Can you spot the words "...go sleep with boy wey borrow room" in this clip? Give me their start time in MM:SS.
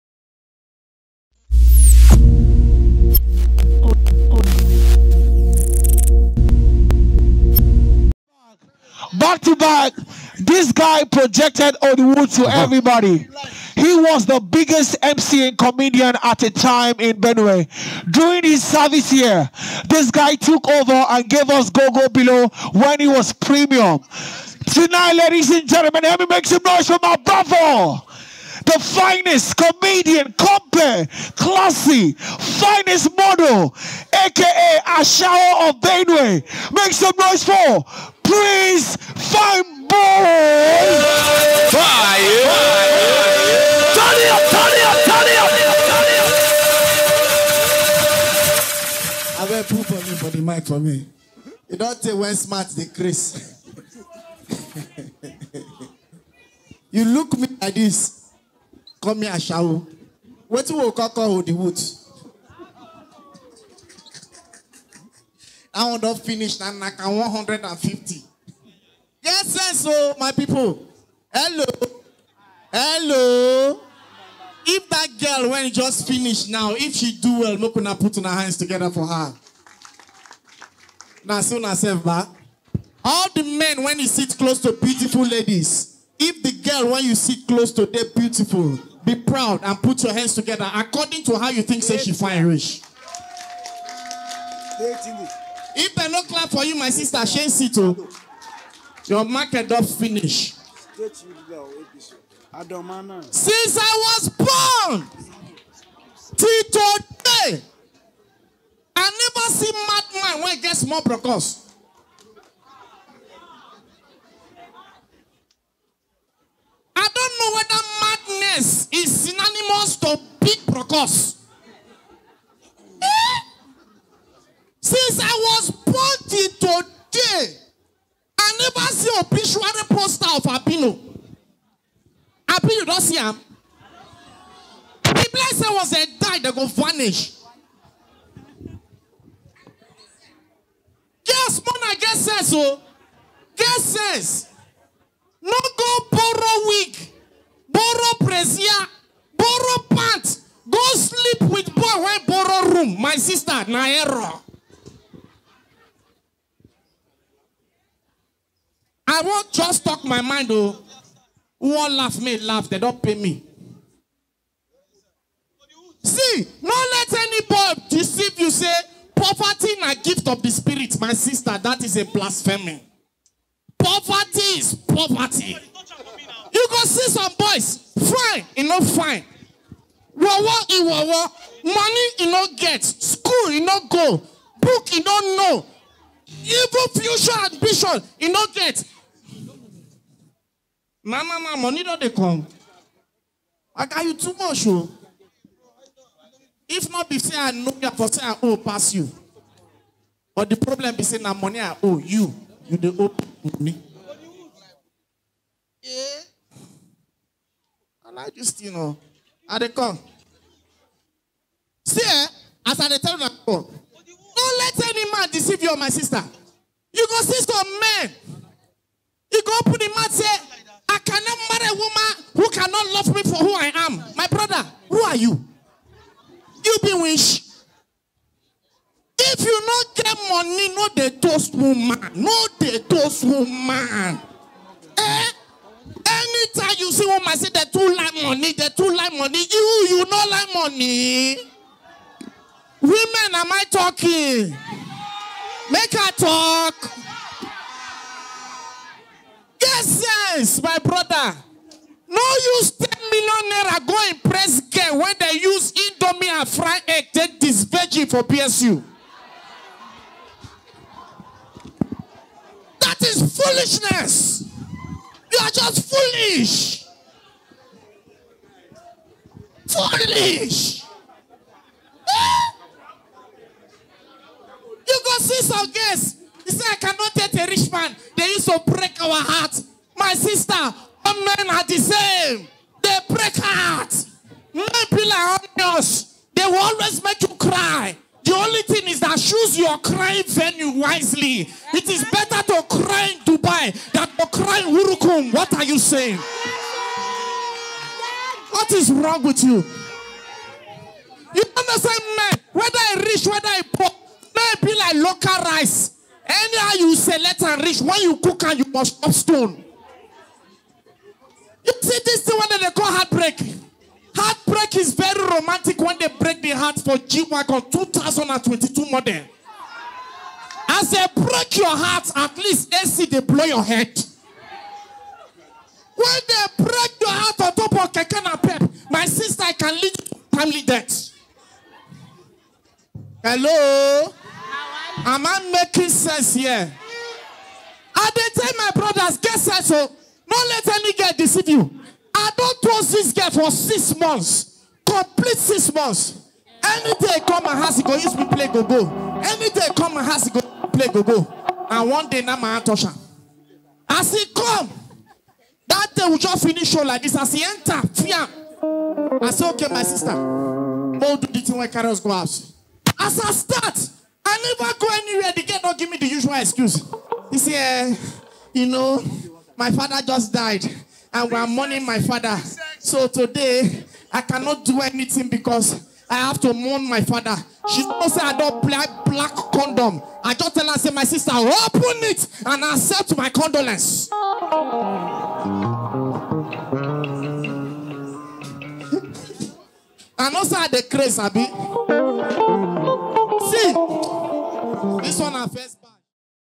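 02:30.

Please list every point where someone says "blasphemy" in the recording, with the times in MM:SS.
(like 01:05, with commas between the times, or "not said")
02:52.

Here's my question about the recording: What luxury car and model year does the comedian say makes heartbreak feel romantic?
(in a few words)
G-Wagon 2022.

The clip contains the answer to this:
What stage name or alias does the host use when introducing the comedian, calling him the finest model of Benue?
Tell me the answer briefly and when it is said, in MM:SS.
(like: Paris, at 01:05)
Ashao of Benue, at 00:34.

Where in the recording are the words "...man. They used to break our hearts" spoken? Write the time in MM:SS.
04:37.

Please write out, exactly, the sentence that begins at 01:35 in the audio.
If they no clap for you, my sister, shame sit o.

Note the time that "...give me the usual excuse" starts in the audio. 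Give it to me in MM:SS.
06:05.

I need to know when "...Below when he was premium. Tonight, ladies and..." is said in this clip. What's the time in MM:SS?
00:22.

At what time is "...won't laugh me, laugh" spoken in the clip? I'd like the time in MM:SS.
02:41.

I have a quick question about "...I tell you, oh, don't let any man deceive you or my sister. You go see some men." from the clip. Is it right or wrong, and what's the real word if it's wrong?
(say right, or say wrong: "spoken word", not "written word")
right.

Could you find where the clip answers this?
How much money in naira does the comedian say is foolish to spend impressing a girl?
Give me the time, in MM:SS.
04:12.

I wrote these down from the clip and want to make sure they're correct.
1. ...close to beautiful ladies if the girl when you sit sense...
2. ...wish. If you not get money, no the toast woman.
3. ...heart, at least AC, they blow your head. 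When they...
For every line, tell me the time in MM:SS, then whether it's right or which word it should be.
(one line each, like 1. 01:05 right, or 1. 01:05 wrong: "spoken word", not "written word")
1. 01:24 wrong: "close", not "sense"
2. 03:46 right
3. 05:21 right.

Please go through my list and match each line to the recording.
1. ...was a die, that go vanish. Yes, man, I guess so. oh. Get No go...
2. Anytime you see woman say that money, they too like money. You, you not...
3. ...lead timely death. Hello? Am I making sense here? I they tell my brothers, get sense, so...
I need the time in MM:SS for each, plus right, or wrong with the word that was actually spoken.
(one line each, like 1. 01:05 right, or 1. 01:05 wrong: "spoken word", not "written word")
1. 02:15 right
2. 03:56 right
3. 05:29 right.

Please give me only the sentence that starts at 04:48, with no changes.
The only thing is that choose your crying venue wisely.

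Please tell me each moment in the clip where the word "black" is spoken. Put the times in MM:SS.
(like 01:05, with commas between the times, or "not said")
06:19.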